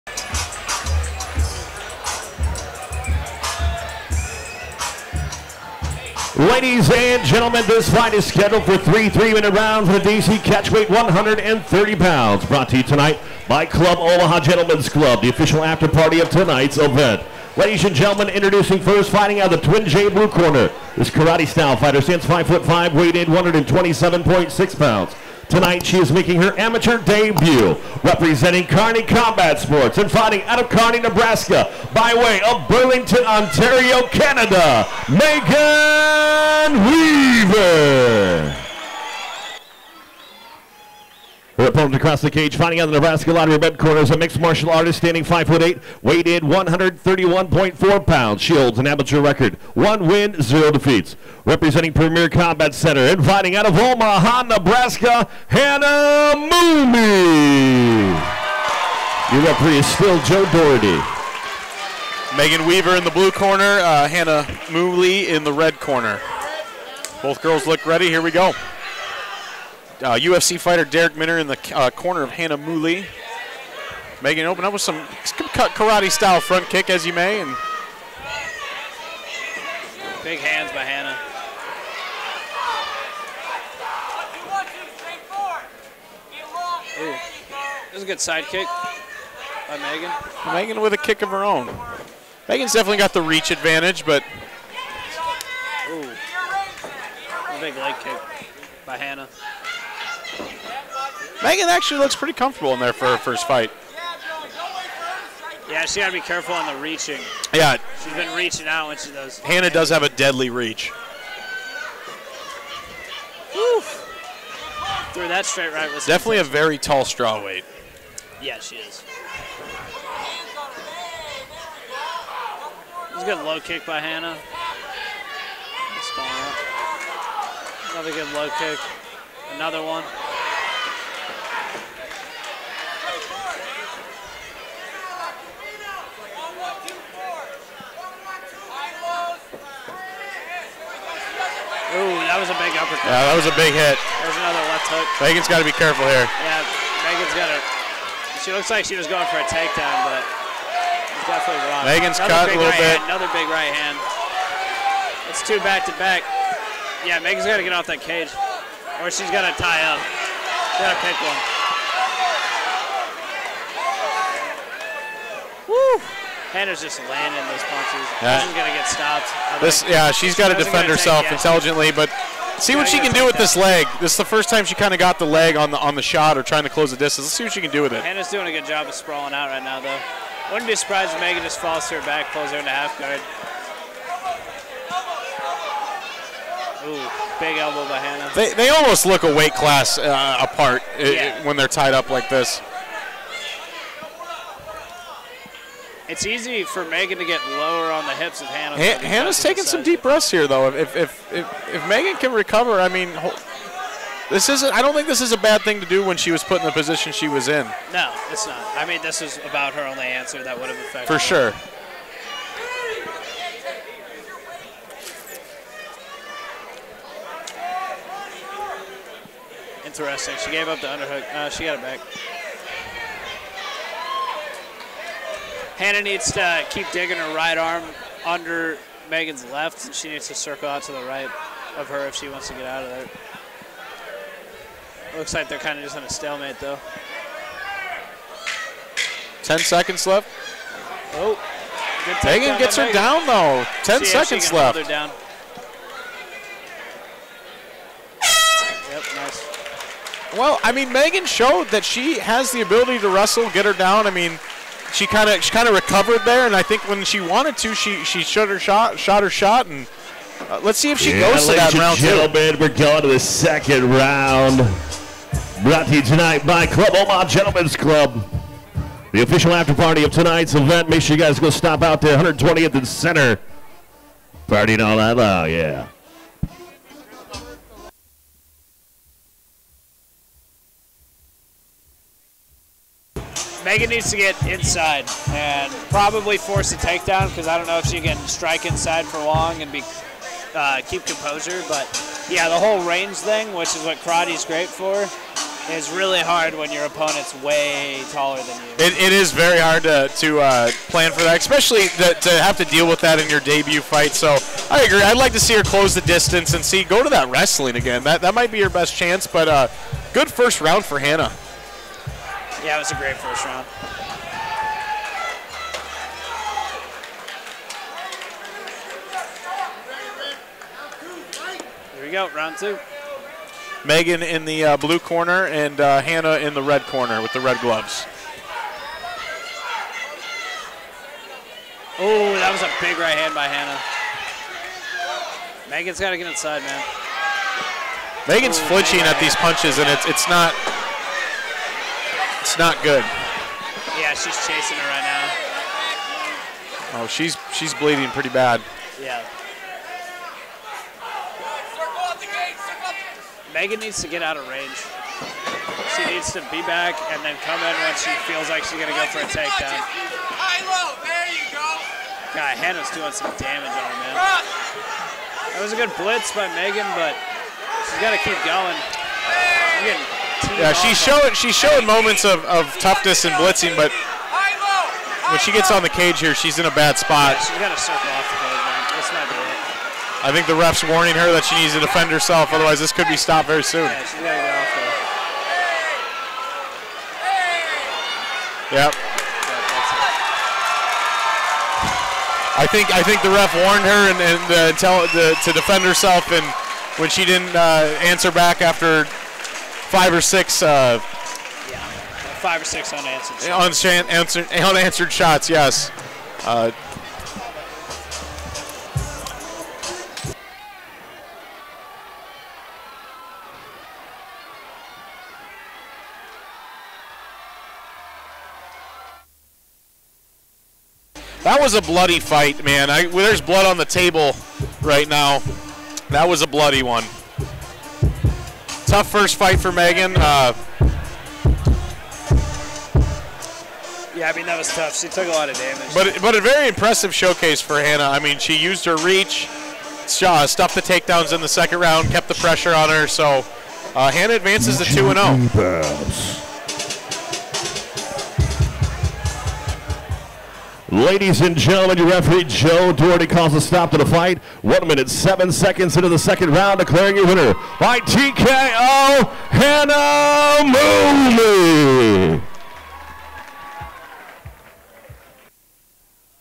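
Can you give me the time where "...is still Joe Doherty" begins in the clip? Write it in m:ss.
0:59.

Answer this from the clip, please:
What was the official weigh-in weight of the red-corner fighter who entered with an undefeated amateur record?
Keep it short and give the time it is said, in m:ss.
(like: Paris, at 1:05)
131.4 pounds, at 0:46.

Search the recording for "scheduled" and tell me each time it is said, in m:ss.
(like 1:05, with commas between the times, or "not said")
0:08.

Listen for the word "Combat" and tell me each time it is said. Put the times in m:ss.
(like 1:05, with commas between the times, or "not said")
0:29, 0:52.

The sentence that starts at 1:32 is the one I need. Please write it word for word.
Megan's definitely got the reach advantage, but.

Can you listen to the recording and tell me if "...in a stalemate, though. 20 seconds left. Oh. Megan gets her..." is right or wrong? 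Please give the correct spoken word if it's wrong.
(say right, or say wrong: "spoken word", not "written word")
wrong: "10", not "20".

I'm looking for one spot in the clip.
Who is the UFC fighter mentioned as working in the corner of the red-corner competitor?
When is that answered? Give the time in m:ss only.
1:10.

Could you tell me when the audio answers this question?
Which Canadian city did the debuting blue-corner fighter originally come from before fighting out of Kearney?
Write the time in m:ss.
0:32.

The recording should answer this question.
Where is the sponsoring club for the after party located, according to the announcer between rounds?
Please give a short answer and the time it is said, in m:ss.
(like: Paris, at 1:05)
120th and Center, at 4:32.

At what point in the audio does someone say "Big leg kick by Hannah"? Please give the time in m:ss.
1:37.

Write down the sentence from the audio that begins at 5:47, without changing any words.
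Oh, she's she's bleeding pretty bad.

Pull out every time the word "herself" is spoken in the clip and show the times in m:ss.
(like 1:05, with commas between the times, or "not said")
2:50, 6:22, 6:35.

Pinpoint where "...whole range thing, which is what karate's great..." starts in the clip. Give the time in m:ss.
4:52.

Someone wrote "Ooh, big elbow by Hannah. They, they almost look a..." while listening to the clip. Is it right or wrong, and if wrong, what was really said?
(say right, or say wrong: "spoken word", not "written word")
right.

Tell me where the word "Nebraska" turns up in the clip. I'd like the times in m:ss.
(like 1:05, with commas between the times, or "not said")
0:31, 0:42, 0:54.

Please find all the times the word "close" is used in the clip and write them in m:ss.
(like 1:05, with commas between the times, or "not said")
2:56, 5:05.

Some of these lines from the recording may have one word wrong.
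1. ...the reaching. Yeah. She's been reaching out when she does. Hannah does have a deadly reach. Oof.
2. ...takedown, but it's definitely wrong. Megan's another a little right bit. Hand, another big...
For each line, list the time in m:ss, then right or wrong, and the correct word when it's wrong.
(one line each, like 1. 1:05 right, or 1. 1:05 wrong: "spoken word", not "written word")
1. 1:46 right
2. 2:29 right.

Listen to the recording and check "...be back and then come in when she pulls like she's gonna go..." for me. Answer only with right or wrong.
wrong.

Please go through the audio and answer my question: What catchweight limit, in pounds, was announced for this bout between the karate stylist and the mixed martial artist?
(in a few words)
130.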